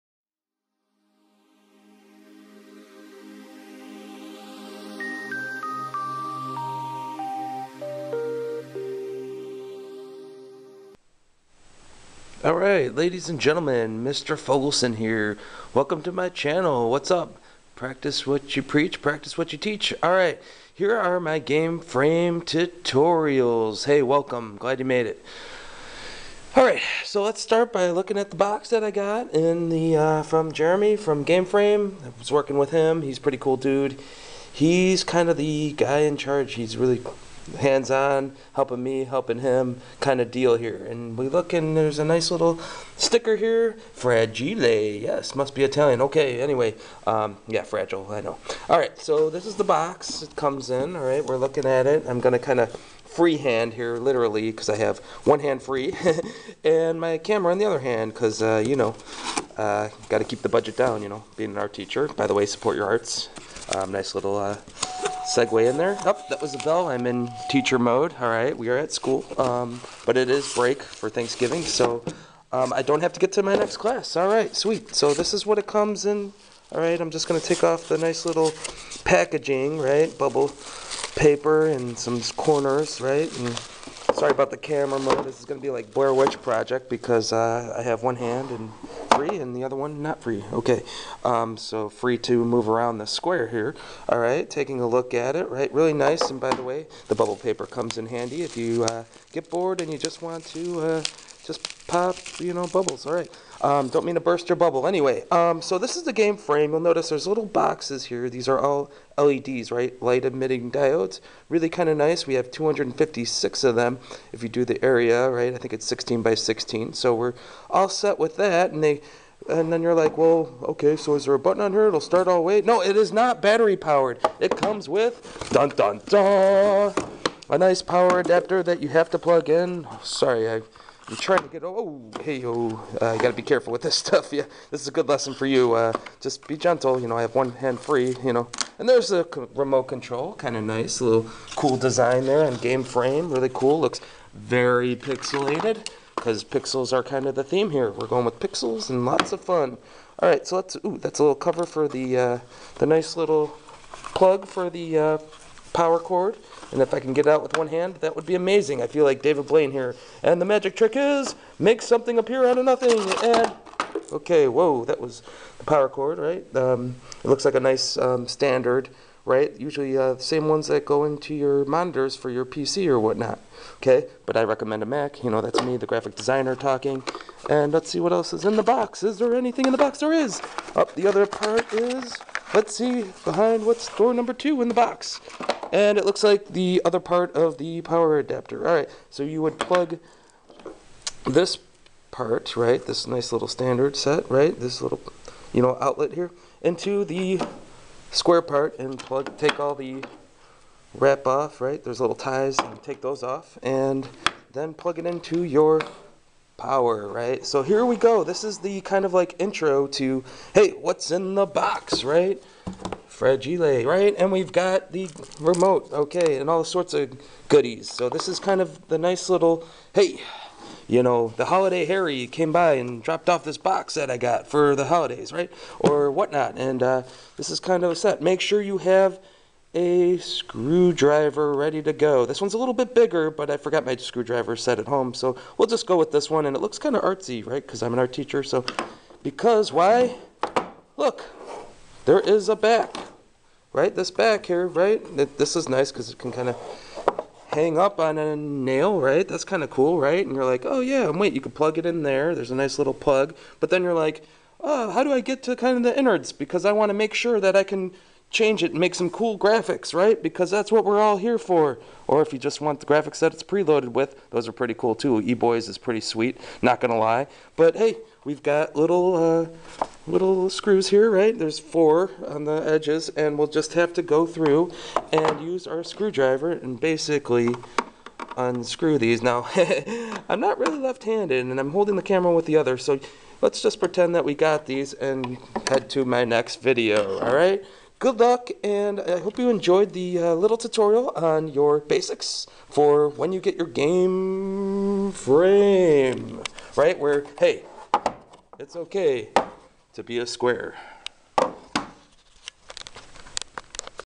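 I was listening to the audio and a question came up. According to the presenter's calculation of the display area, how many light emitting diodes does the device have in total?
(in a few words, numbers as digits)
256.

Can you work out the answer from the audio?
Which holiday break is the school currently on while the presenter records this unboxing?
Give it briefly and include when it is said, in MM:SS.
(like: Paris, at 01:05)
Thanksgiving, at 01:11.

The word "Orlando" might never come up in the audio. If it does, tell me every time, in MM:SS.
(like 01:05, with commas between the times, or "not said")
not said.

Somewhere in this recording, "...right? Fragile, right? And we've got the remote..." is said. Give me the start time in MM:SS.
03:32.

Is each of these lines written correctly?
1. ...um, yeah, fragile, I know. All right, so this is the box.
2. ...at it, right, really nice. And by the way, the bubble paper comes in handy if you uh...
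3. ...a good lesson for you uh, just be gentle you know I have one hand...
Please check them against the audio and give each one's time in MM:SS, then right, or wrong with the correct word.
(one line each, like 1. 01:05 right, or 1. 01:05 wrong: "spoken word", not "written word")
1. 00:47 right
2. 01:35 right
3. 02:14 right.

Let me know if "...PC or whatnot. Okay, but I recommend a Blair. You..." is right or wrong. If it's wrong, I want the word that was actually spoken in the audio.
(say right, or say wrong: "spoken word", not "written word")
wrong: "Mac", not "Blair".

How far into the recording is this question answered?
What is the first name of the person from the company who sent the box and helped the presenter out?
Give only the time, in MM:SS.
00:30.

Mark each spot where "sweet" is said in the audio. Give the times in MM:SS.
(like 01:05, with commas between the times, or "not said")
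01:14, 04:25.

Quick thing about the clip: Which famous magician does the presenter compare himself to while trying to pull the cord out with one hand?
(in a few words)
David Blaine.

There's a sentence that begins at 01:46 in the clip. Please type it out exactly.
You'll notice there's little boxes here.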